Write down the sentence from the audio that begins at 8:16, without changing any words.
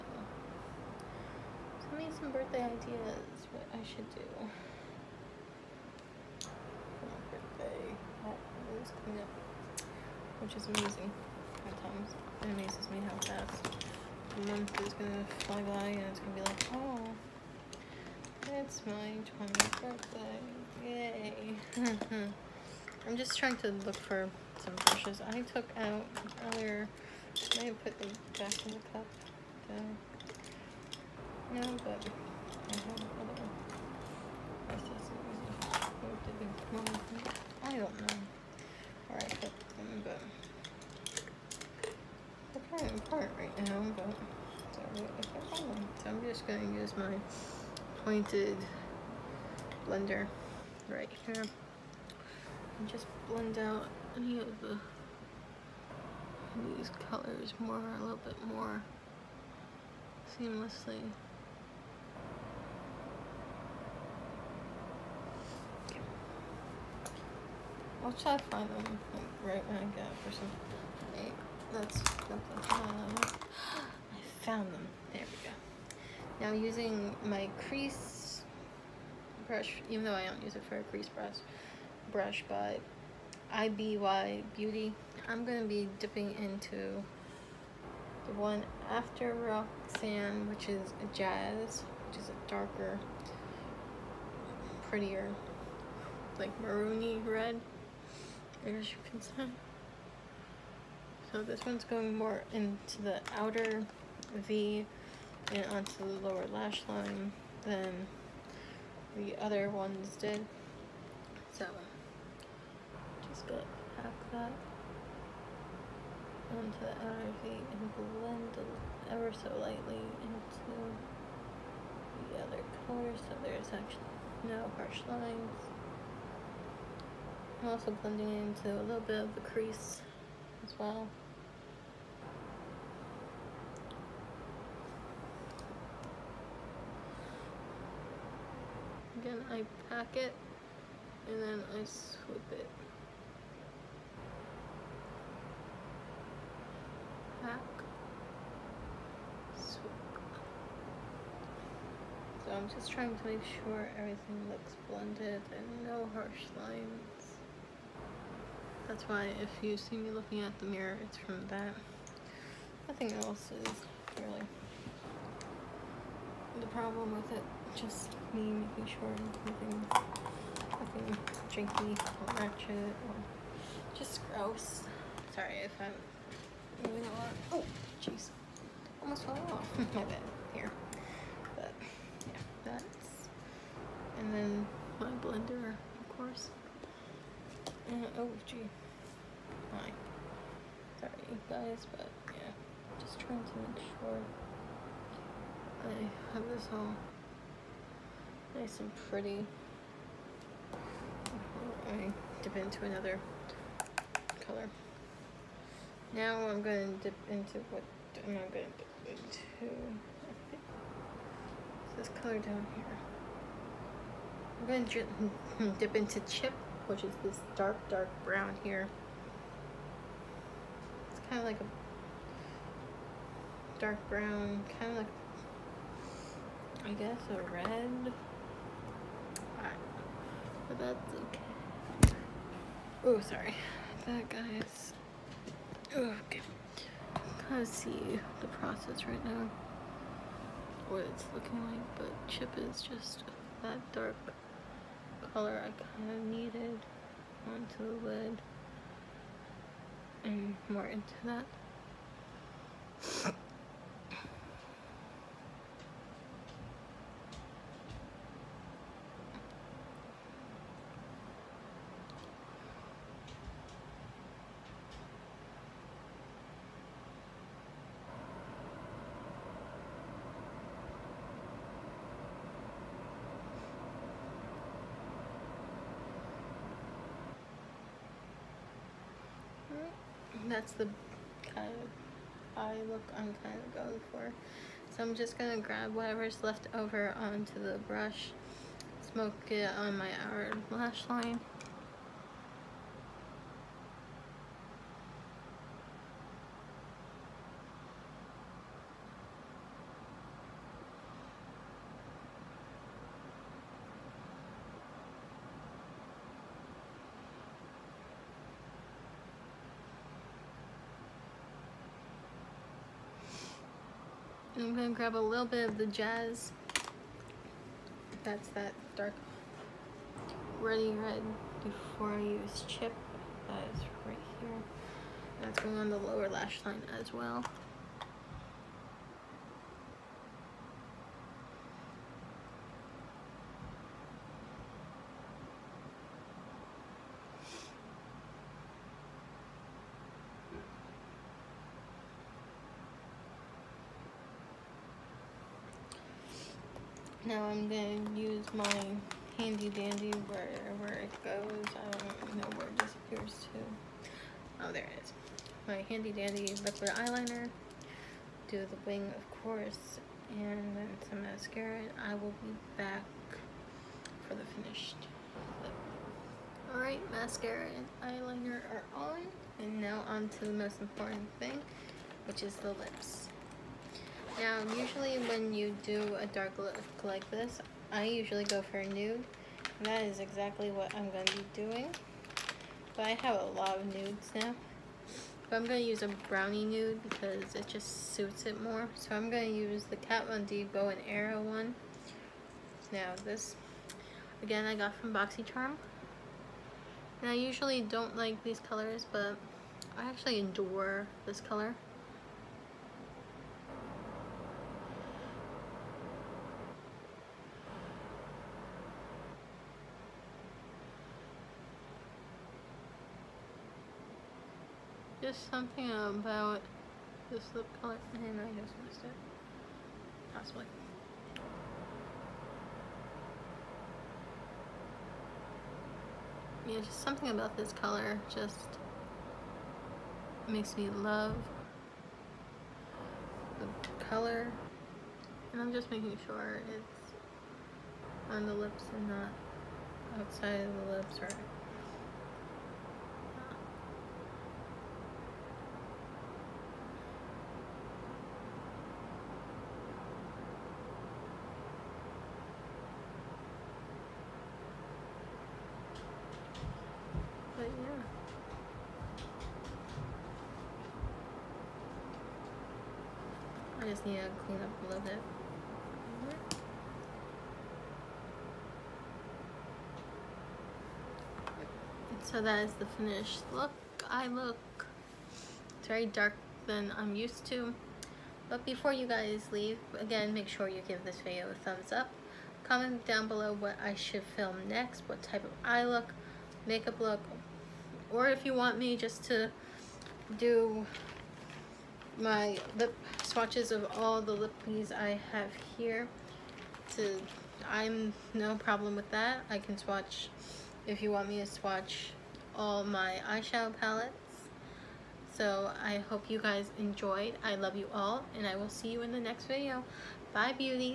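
To, I'm no problem with that.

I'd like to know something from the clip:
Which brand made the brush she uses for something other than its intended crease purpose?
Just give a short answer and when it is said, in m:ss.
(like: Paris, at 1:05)
IBY Beauty, at 1:23.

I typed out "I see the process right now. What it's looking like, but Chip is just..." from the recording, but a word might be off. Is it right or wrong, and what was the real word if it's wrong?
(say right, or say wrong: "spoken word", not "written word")
right.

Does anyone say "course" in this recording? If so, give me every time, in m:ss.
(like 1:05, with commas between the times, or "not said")
3:06, 5:59.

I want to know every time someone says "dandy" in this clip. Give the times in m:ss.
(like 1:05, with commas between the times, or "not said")
5:49, 5:56.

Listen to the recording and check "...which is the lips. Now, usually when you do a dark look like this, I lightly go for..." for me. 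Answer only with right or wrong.
wrong.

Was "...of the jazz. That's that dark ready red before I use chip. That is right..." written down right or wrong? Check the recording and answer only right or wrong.
right.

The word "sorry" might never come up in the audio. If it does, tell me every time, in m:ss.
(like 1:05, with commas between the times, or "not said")
2:55, 3:10, 3:53.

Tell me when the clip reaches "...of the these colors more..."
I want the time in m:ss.
0:54.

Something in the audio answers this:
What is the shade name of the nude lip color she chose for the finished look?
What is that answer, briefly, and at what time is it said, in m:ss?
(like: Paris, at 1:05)
Bow and arrow, at 6:30.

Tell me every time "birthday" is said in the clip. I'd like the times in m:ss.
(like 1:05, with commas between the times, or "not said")
0:02, 0:07, 0:19.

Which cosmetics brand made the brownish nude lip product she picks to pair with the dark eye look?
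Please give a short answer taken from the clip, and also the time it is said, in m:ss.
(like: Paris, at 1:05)
Kat Von D, at 6:29.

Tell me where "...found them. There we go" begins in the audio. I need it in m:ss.
1:14.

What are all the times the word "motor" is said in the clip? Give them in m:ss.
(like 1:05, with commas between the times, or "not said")
not said.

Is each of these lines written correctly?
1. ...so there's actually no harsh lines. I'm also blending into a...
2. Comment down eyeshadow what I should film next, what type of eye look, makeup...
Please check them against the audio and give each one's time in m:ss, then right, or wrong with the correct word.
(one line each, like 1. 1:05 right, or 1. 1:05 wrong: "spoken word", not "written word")
1. 2:03 right
2. 8:02 wrong: "below", not "eyeshadow".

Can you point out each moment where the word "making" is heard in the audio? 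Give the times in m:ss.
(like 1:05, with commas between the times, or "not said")
2:48, 7:15.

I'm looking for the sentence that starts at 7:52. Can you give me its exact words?
So that is the finished look.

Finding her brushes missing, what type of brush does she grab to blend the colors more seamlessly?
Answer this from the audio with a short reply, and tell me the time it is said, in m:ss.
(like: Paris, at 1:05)
Pointed blender, at 0:48.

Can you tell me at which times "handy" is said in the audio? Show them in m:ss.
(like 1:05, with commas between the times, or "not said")
5:49, 5:55.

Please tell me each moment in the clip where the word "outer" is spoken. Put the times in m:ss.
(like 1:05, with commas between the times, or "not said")
1:43, 1:57, 4:50.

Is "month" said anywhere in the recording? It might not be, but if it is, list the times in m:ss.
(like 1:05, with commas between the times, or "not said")
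0:14.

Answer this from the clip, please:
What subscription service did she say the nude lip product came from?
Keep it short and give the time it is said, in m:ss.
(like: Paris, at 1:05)
BoxyCharm, at 6:35.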